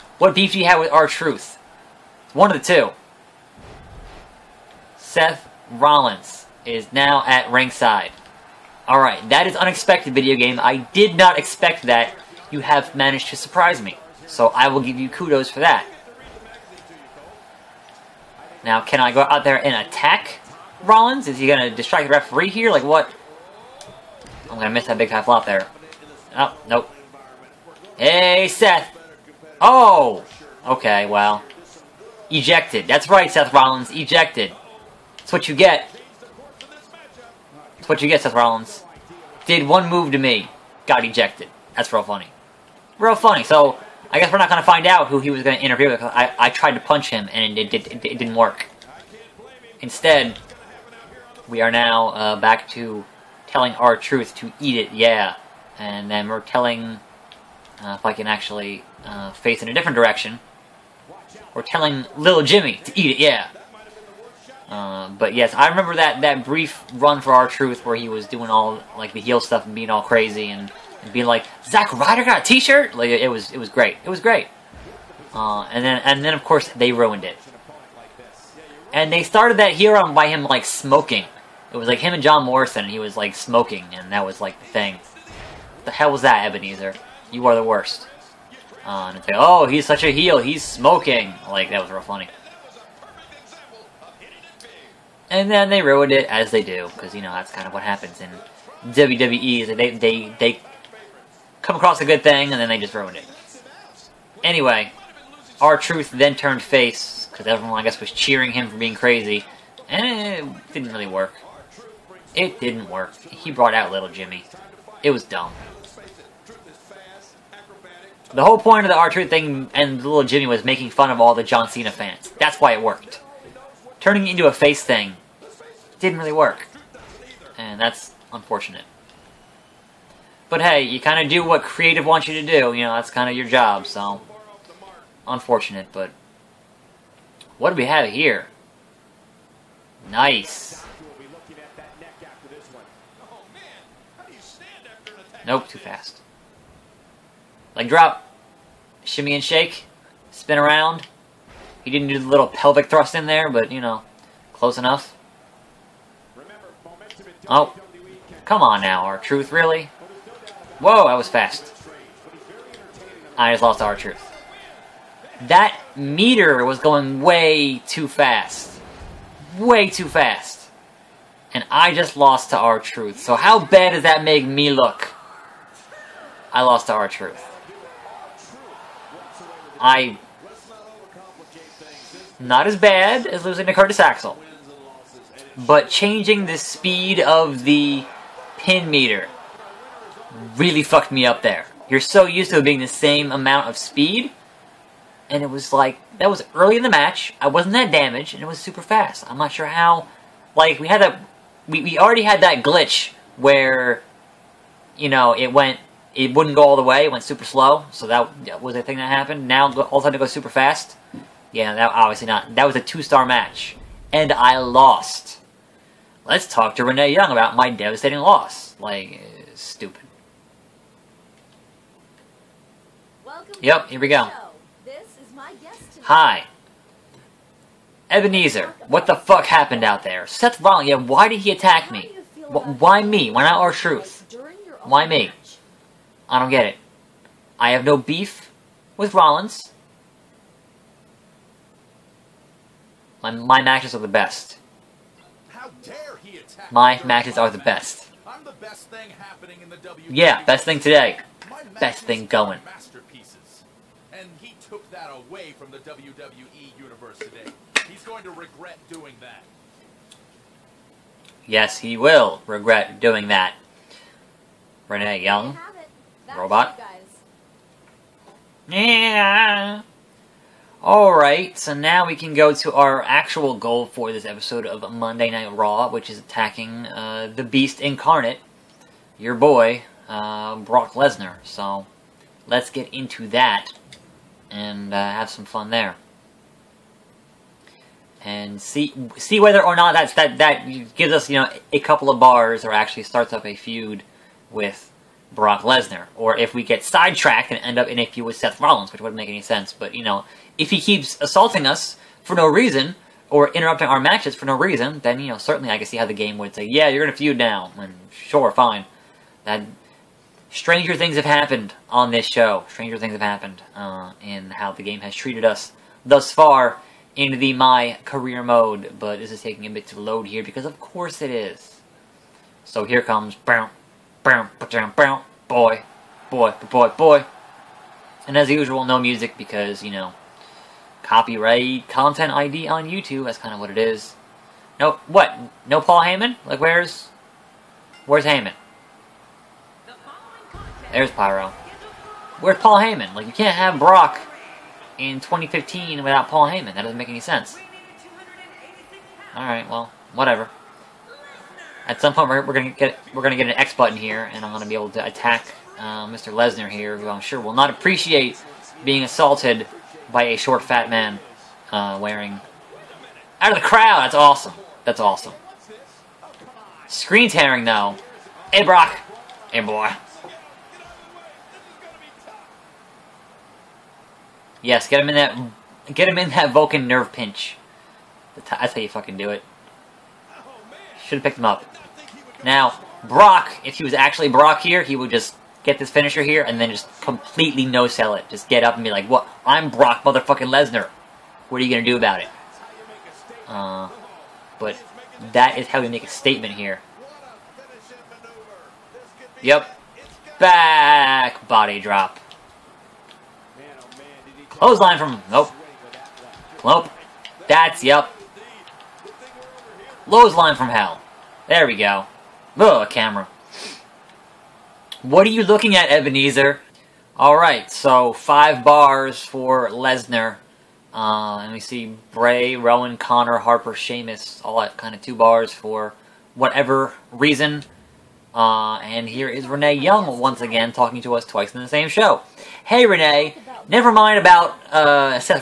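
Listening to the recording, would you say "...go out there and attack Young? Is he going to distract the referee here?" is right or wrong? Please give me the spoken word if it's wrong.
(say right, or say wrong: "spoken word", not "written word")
wrong: "Rollins", not "Young".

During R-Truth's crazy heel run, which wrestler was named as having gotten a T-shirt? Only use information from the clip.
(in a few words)
Zack Ryder.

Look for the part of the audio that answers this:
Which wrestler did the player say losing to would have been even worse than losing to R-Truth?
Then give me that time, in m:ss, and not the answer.
3:03.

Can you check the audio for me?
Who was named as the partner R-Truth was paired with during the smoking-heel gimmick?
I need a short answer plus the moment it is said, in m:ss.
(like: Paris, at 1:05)
John Morrison, at 1:22.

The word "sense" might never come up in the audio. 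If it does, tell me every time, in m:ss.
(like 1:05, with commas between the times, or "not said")
4:59, 5:47.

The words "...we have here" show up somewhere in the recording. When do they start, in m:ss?
2:17.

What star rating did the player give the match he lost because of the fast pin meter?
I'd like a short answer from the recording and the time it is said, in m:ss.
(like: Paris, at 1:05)
2, at 3:32.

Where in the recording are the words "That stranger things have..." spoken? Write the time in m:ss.
5:09.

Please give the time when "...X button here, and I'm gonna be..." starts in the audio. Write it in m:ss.
5:53.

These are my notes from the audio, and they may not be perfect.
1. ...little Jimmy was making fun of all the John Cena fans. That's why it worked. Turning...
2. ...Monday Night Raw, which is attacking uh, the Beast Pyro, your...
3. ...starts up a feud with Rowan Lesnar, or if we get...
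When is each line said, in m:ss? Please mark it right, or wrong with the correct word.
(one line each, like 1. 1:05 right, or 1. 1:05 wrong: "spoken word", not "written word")
1. 1:59 right
2. 4:34 wrong: "Incarnate", not "Pyro"
3. 4:53 wrong: "Brock", not "Rowan".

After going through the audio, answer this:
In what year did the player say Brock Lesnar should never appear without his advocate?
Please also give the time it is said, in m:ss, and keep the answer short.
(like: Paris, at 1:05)
2015, at 5:45.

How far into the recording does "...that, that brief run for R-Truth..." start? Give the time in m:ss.
1:05.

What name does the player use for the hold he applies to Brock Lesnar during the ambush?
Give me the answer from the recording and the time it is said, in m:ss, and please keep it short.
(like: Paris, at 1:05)
Vulcan nerve pinch, at 6:16.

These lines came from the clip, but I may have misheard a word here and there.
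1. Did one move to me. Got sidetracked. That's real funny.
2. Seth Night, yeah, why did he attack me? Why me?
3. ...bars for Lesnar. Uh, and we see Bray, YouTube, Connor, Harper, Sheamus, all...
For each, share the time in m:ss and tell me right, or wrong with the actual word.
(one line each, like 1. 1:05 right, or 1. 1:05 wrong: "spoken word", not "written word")
1. 0:39 wrong: "ejected", not "sidetracked"
2. 3:50 wrong: "Rollins", not "Night"
3. 6:58 wrong: "Rowan", not "YouTube".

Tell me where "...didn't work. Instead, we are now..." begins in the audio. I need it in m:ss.
0:48.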